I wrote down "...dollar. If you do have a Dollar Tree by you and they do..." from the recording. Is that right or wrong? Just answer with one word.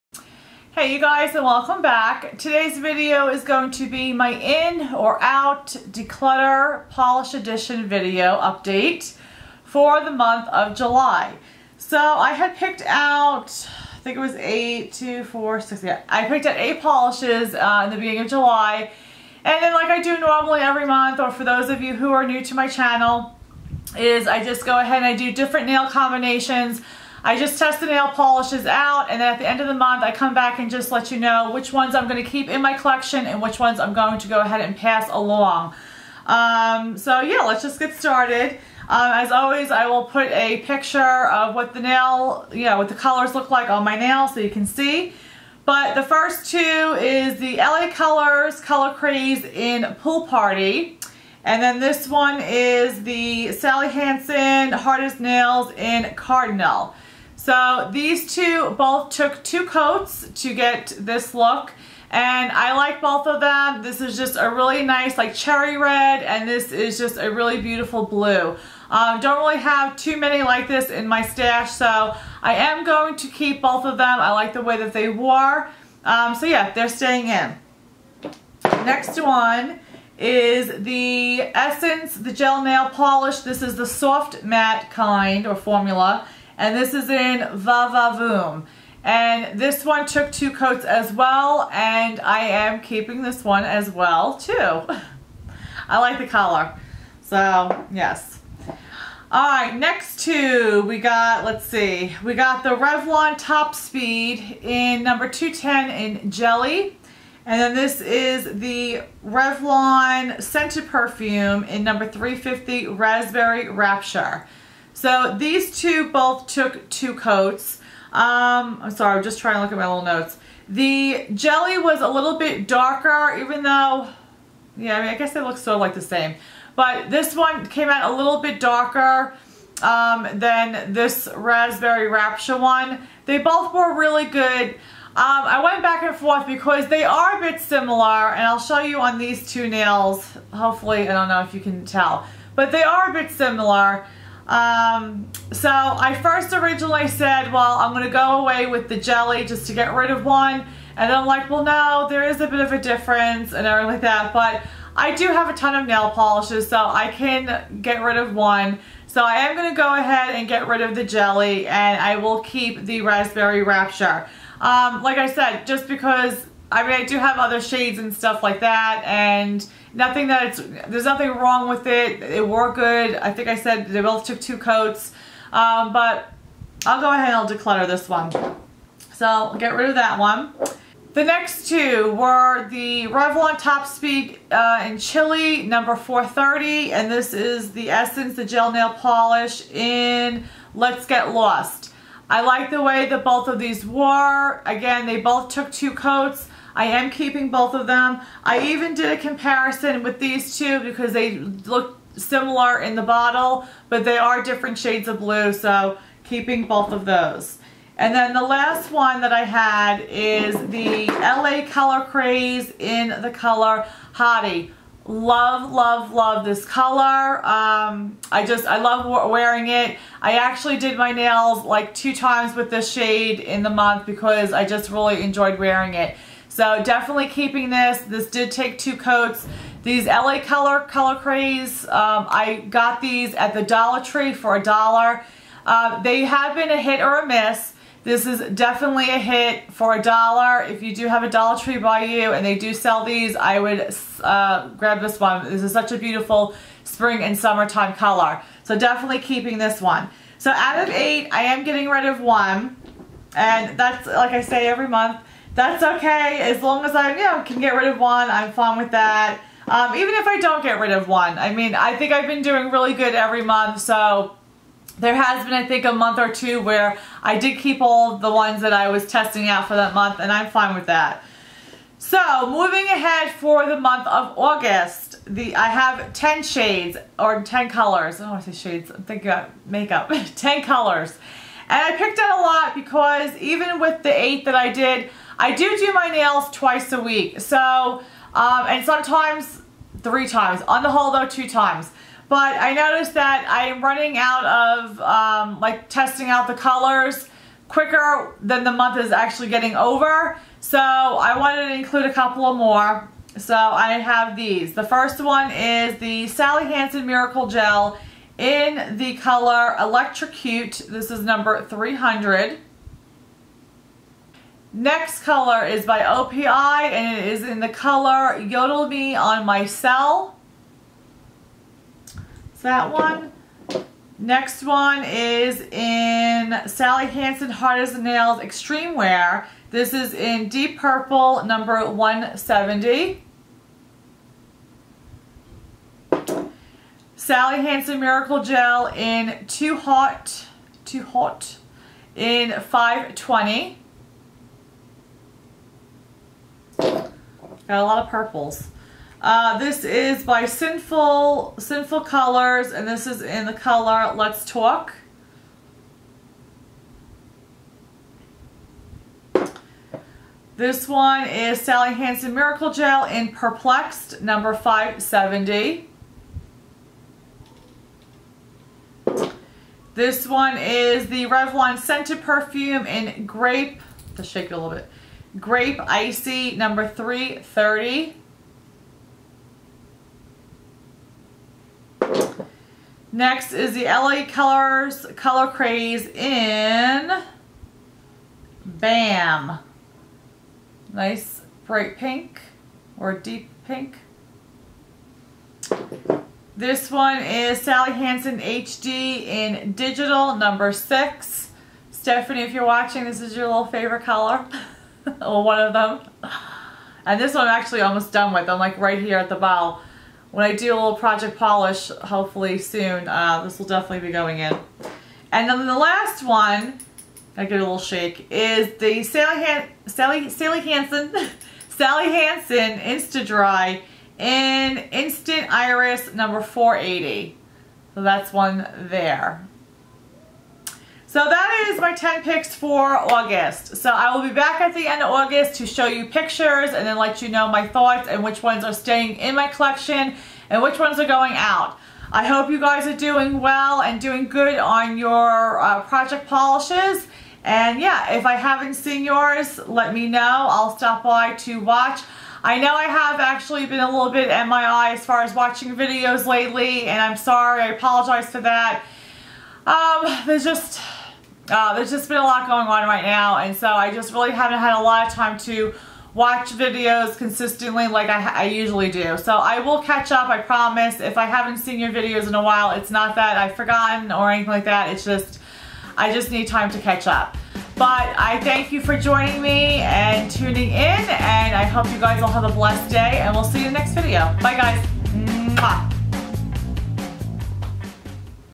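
right.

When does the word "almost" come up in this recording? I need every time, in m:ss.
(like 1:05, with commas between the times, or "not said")
6:47.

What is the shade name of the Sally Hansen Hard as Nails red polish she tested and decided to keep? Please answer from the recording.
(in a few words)
Cardinal.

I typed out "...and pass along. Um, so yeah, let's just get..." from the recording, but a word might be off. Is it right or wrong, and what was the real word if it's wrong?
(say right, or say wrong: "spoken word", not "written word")
right.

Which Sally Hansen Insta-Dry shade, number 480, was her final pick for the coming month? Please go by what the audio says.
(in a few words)
Instant Iris.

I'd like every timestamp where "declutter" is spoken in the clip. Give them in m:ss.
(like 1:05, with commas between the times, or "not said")
0:05, 2:57.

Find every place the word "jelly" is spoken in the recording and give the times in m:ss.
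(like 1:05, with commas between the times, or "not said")
1:46, 2:01, 2:28, 2:41.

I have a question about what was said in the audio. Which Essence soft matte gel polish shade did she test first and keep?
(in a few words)
Voom.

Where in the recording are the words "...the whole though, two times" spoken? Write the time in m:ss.
4:50.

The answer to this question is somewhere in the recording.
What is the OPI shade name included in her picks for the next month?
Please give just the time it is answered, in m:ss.
5:18.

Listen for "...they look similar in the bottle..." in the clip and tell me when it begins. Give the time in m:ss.
3:21.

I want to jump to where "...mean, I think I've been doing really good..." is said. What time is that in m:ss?
4:21.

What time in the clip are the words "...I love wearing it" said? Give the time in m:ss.
3:38.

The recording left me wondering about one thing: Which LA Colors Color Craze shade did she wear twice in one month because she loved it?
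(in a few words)
Hottie.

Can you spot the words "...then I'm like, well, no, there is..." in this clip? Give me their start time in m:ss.
2:31.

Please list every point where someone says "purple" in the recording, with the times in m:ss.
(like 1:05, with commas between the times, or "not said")
5:30, 5:48.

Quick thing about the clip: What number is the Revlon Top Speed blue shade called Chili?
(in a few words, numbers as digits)
430.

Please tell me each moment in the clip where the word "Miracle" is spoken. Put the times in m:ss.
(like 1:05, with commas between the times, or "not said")
5:07, 5:37, 6:02.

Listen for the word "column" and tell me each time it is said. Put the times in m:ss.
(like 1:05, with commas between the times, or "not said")
not said.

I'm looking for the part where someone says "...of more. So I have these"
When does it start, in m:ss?
5:02.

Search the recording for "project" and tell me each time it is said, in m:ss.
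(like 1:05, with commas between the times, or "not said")
6:50, 7:25.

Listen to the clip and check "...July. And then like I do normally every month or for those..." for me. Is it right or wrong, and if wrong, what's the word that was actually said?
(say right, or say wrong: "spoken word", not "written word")
right.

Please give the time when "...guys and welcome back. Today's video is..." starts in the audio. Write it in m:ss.
0:01.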